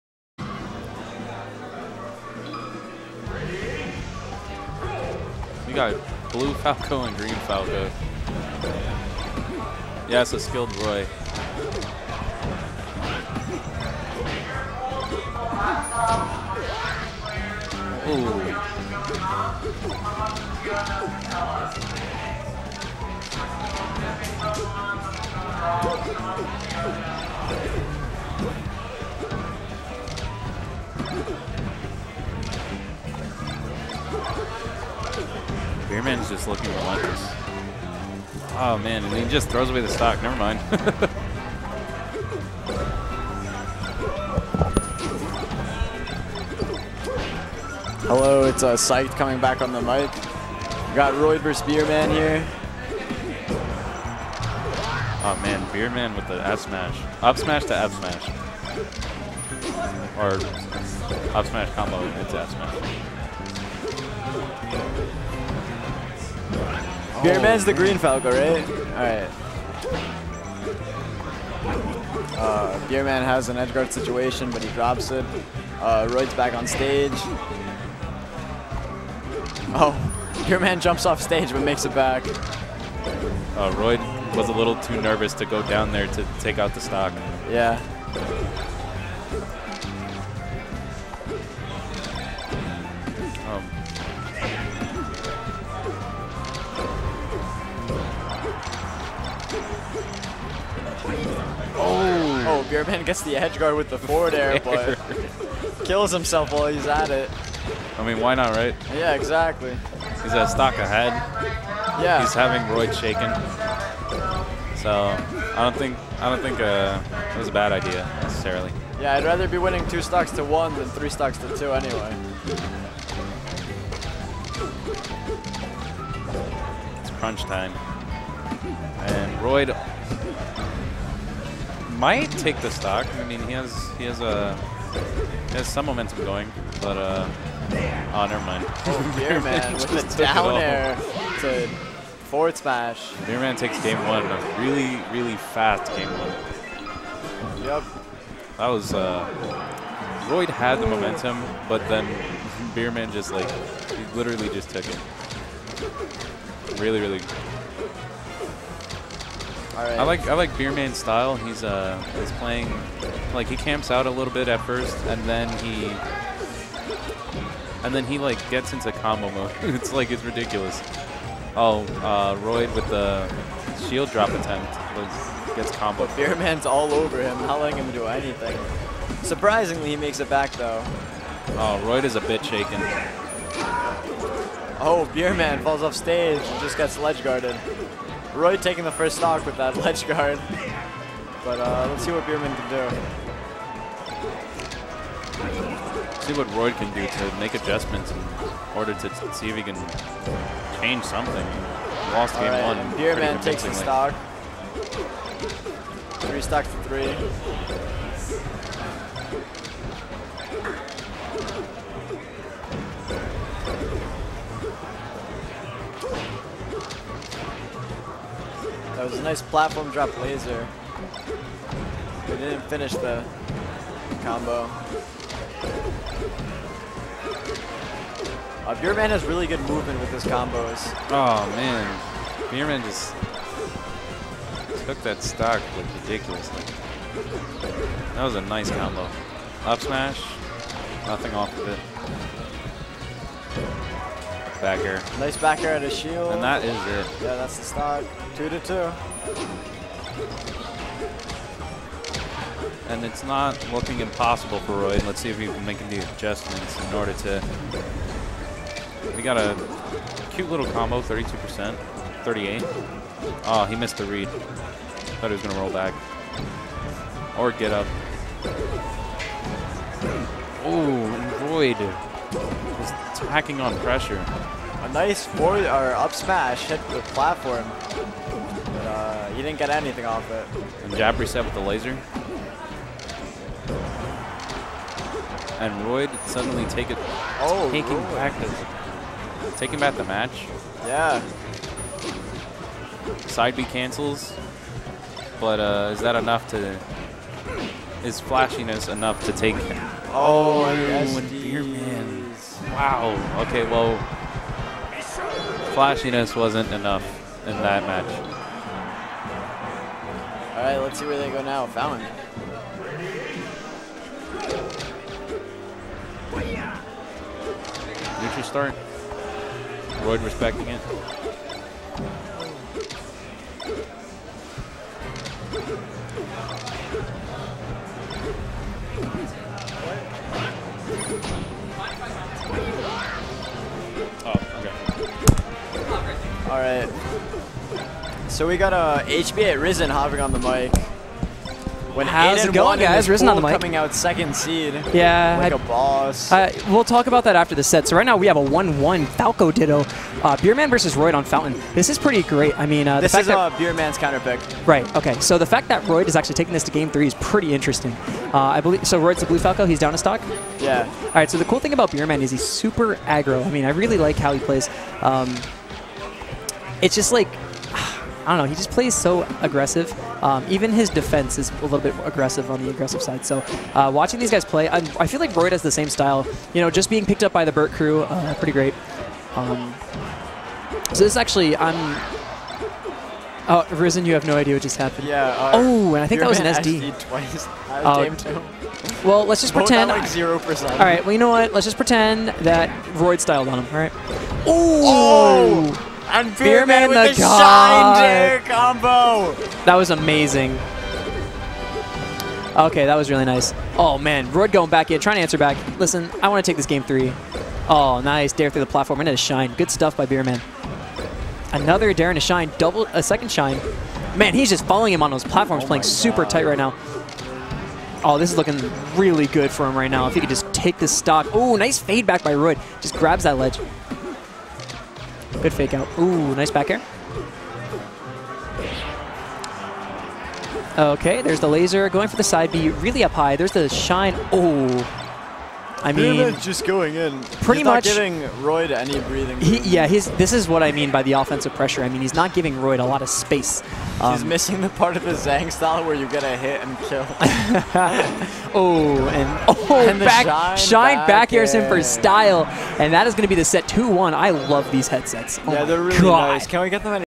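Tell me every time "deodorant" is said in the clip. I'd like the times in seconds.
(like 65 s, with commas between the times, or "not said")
not said.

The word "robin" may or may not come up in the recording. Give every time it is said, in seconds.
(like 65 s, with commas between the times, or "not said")
not said.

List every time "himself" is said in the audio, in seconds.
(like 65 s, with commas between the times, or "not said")
106 s.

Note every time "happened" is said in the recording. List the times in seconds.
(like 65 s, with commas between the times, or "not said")
384 s.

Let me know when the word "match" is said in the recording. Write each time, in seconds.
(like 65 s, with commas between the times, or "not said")
290 s, 307 s.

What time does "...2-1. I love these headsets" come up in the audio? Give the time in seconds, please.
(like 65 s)
453 s.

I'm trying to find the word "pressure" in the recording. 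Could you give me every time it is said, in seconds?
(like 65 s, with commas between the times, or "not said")
273 s, 441 s.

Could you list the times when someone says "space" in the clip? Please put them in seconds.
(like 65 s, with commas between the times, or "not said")
443 s.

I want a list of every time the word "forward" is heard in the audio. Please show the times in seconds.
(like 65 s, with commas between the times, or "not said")
103 s, 142 s, 275 s.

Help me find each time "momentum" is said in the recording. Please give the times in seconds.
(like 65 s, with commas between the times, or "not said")
135 s, 150 s.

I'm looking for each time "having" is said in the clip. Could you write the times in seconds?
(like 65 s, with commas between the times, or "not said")
112 s.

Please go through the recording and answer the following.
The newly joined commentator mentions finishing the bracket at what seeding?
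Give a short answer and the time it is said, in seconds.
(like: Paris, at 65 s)
second seed, at 343 s.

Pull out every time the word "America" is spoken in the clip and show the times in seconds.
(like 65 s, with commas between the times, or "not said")
not said.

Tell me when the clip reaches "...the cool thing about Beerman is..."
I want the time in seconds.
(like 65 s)
361 s.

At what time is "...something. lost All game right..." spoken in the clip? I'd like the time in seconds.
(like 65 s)
201 s.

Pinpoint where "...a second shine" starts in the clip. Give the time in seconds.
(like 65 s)
412 s.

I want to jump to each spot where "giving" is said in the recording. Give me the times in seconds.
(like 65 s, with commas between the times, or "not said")
437 s, 442 s.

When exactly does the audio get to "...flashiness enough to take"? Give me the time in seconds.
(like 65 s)
298 s.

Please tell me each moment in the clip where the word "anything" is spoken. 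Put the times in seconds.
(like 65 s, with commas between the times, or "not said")
178 s, 279 s.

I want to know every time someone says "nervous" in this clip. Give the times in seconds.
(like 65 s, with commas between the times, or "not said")
85 s.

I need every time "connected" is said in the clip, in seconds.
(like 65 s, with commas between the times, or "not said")
not said.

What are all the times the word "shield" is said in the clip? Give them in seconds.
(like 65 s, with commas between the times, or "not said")
173 s, 245 s.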